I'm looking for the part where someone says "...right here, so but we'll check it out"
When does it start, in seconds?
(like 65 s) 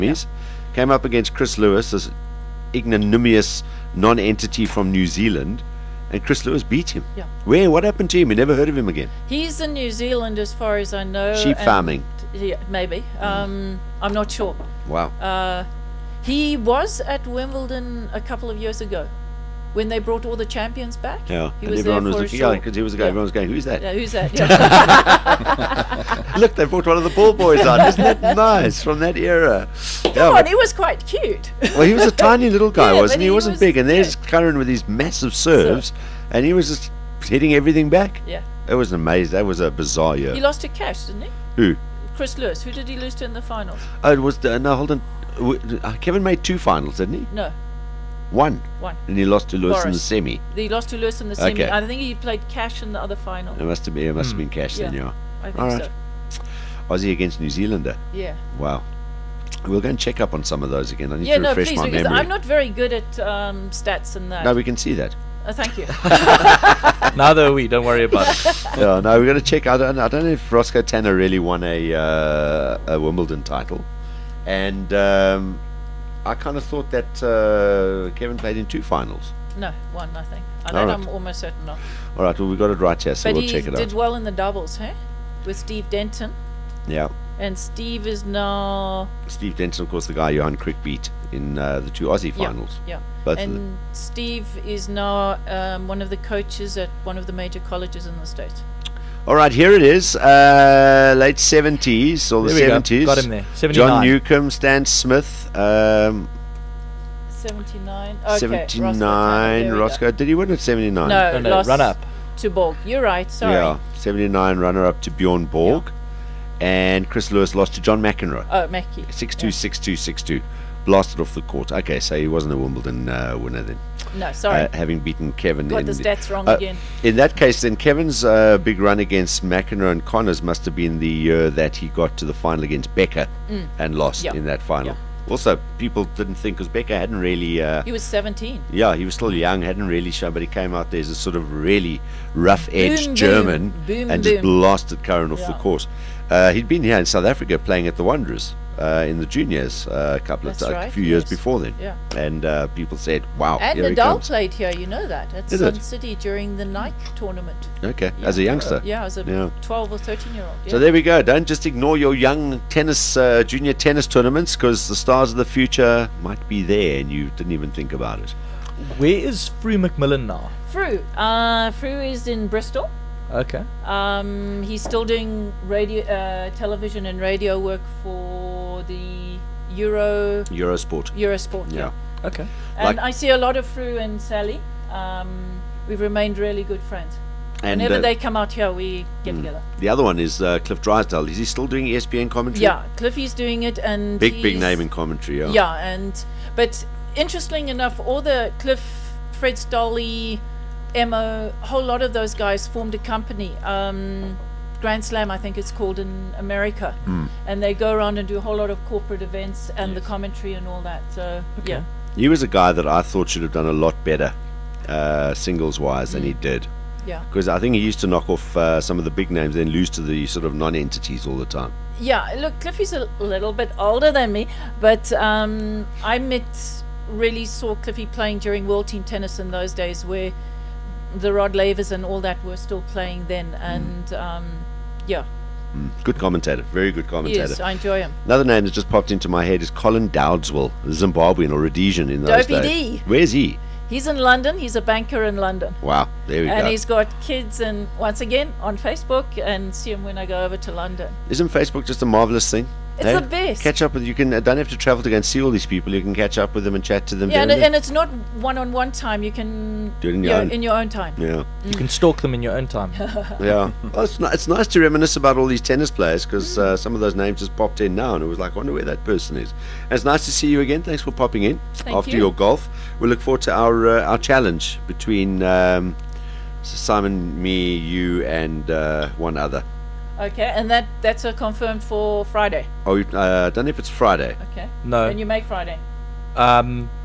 82 s.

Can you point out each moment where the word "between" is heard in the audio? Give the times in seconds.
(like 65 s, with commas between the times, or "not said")
274 s.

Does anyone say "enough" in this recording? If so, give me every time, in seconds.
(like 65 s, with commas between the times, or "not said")
197 s.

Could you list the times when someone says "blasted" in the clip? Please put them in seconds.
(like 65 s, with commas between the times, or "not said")
120 s, 144 s.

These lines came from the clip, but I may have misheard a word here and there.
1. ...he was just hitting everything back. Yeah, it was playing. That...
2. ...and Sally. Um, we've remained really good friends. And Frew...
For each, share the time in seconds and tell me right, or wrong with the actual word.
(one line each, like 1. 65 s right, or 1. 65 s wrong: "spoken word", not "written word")
1. 36 s wrong: "amazing", not "playing"
2. 183 s wrong: "Whenever", not "Frew".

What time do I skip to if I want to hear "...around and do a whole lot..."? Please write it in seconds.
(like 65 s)
207 s.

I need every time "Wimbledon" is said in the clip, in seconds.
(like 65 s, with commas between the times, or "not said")
17 s, 73 s, 122 s.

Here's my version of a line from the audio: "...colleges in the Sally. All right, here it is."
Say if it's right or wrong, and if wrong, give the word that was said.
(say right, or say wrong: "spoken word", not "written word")
wrong: "States", not "Sally".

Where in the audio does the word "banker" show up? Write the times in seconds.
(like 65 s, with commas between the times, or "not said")
244 s.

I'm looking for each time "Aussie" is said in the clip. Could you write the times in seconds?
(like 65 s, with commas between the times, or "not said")
56 s, 92 s.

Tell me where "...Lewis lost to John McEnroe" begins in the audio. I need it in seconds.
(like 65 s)
117 s.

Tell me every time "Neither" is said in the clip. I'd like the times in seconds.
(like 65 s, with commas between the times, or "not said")
67 s.